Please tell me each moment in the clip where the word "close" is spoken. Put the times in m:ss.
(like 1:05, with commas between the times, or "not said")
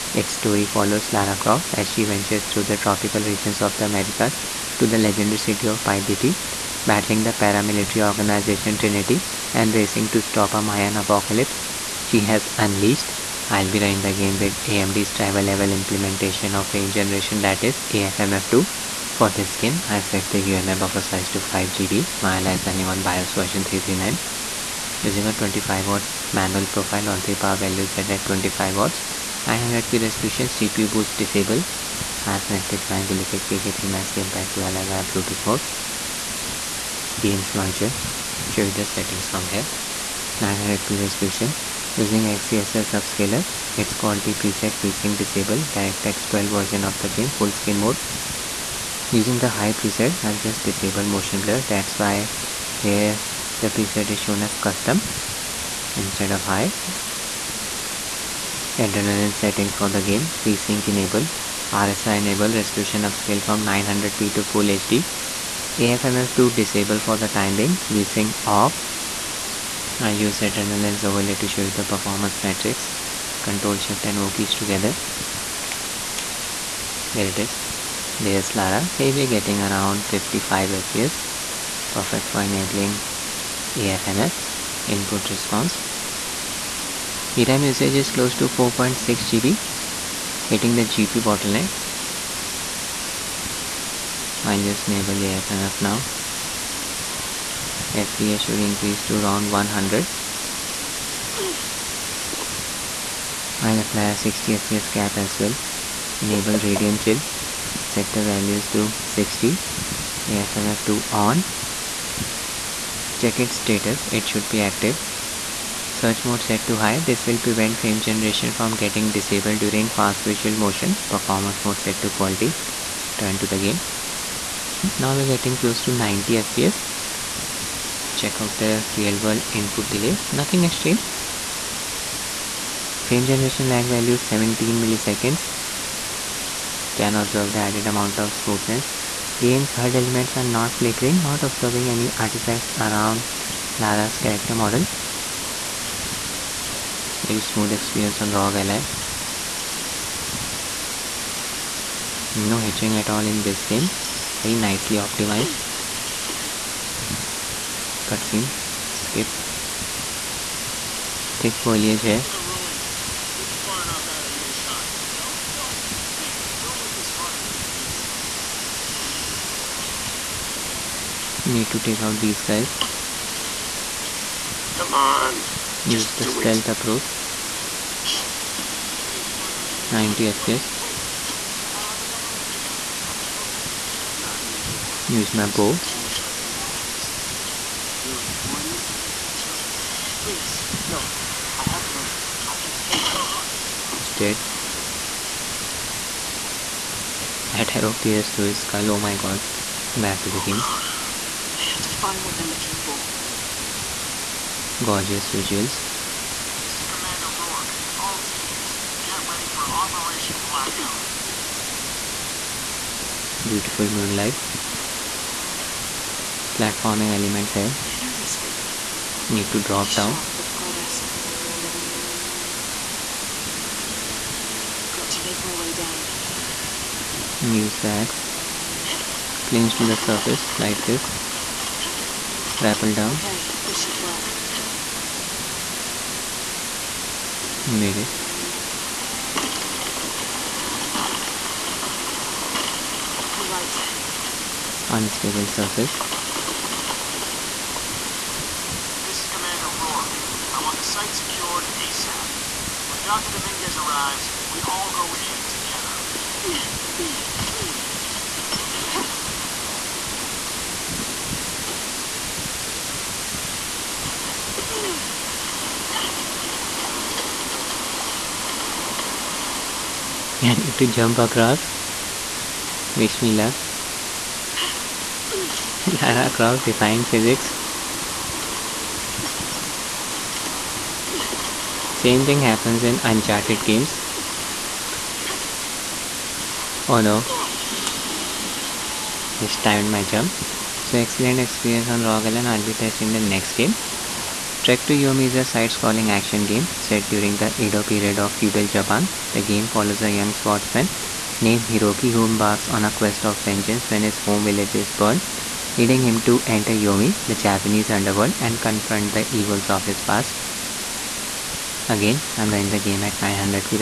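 1:28, 2:05.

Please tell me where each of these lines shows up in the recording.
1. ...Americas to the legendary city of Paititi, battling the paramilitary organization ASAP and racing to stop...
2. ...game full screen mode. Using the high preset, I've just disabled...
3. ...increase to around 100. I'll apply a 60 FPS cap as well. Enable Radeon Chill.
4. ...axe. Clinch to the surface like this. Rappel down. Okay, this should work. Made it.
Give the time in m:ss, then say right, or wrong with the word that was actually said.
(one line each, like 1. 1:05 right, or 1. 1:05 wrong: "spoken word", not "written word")
1. 0:03 wrong: "Trinity", not "ASAP"
2. 0:47 right
3. 1:38 right
4. 3:47 right.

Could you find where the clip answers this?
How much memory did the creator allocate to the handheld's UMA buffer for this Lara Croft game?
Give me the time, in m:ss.
0:21.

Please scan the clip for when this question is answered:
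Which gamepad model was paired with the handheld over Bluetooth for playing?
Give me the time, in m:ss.
0:33.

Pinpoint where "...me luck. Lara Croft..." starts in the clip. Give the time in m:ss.
4:33.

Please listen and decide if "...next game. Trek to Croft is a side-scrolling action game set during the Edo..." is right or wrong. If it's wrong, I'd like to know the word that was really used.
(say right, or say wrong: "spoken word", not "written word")
wrong: "Yomi", not "Croft".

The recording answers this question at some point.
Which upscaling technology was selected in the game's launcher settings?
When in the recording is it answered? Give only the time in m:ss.
0:42.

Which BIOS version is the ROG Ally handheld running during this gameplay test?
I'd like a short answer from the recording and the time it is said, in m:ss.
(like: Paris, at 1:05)
339, at 0:23.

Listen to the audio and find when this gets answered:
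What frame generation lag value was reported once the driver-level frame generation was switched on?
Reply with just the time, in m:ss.
2:14.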